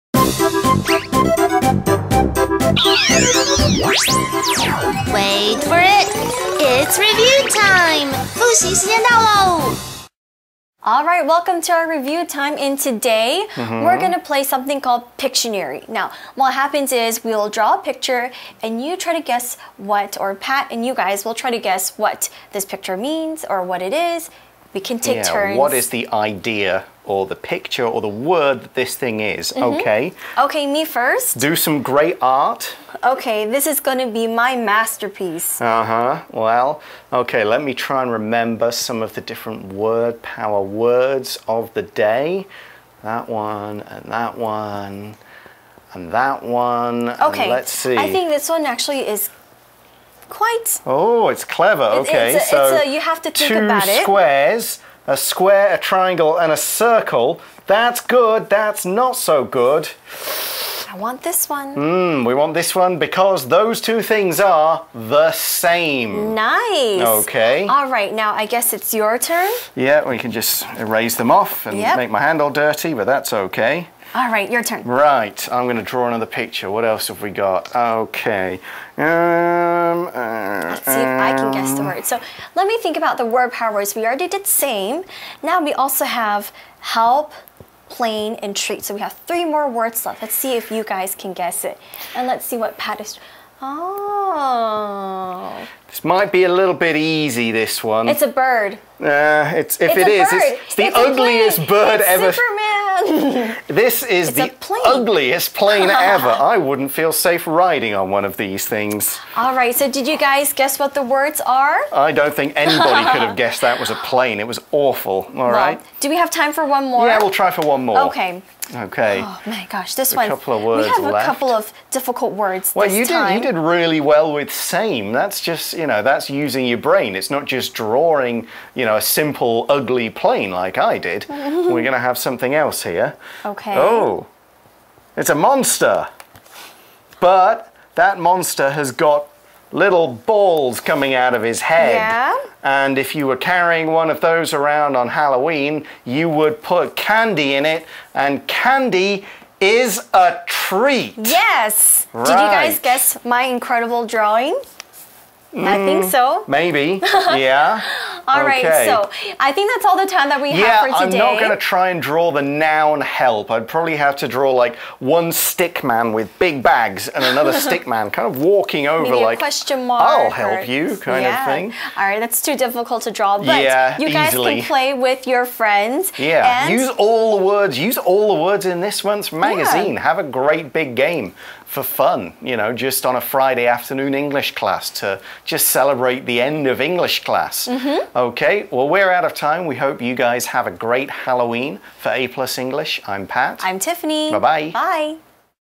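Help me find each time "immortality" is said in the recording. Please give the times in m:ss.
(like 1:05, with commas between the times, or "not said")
not said.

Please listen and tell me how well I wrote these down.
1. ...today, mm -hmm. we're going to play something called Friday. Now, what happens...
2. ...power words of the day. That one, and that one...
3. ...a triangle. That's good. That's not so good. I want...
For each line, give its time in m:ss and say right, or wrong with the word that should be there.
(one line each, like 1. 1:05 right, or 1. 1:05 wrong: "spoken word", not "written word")
1. 0:12 wrong: "Pictionary", not "Friday"
2. 0:40 right
3. 0:56 wrong: "circle", not "triangle".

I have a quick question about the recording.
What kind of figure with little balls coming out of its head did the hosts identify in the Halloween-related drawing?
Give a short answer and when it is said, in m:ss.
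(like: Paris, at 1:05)
a monster, at 2:15.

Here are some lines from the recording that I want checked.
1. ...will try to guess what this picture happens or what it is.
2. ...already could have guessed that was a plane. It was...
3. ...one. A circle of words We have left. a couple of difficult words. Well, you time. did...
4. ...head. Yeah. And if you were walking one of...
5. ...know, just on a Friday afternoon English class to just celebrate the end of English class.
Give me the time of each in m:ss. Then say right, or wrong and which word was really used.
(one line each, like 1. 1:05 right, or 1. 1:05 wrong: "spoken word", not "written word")
1. 0:21 wrong: "means", not "happens"
2. 1:52 wrong: "anybody", not "already"
3. 2:00 wrong: "couple", not "circle"
4. 2:21 wrong: "carrying", not "walking"
5. 3:02 right.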